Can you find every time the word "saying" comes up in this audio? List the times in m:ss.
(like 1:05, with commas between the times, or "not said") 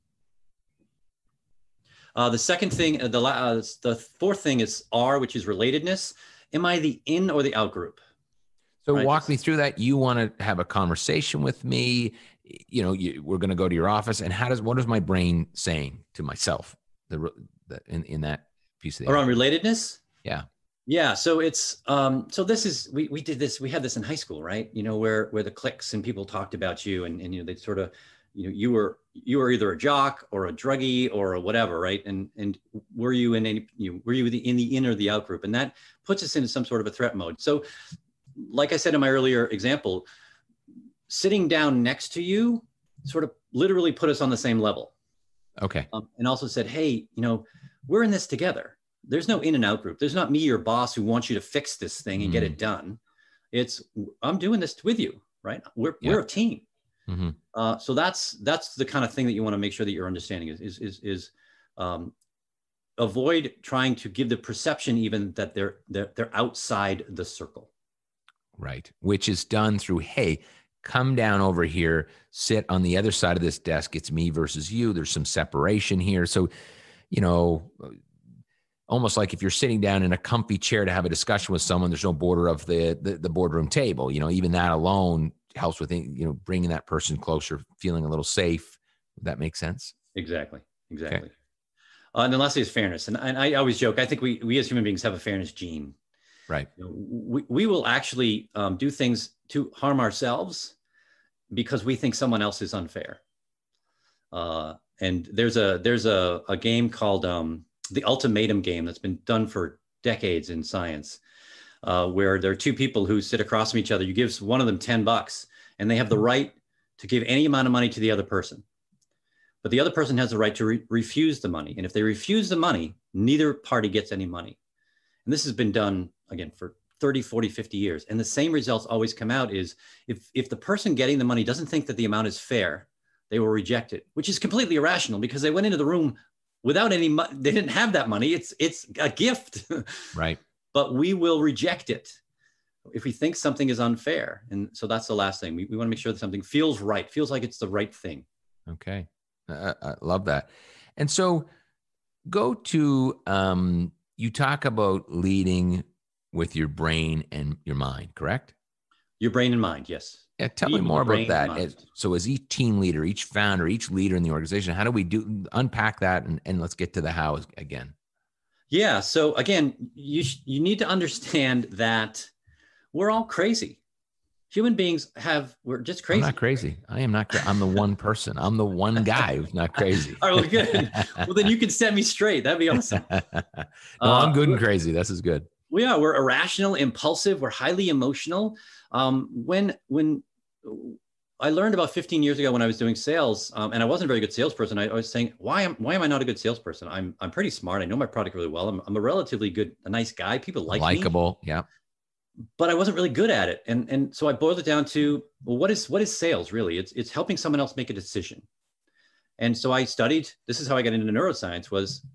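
0:15, 3:15.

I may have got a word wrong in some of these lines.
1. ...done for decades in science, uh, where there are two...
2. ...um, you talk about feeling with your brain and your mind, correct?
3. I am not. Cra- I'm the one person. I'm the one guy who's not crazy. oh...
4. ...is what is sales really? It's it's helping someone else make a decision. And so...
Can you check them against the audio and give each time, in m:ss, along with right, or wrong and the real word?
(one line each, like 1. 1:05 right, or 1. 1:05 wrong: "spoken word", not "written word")
1. 1:49 right
2. 2:33 wrong: "leading", not "feeling"
3. 2:56 right
4. 3:25 right.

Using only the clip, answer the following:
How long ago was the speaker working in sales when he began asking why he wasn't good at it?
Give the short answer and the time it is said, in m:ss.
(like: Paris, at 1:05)
about 15 years, at 3:11.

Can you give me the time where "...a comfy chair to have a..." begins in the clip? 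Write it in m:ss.
1:20.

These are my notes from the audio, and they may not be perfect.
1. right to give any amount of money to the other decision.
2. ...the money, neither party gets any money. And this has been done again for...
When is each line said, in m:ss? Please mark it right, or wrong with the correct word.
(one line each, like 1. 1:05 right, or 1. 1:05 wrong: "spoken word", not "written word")
1. 1:56 wrong: "person", not "decision"
2. 2:02 right.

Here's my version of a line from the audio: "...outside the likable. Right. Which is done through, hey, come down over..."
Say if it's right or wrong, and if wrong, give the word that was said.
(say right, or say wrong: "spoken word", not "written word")
wrong: "circle", not "likable".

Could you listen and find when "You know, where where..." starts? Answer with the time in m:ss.
0:24.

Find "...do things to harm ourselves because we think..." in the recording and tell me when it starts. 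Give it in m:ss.
1:38.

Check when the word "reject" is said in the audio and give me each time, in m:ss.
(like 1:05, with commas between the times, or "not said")
2:13, 2:21.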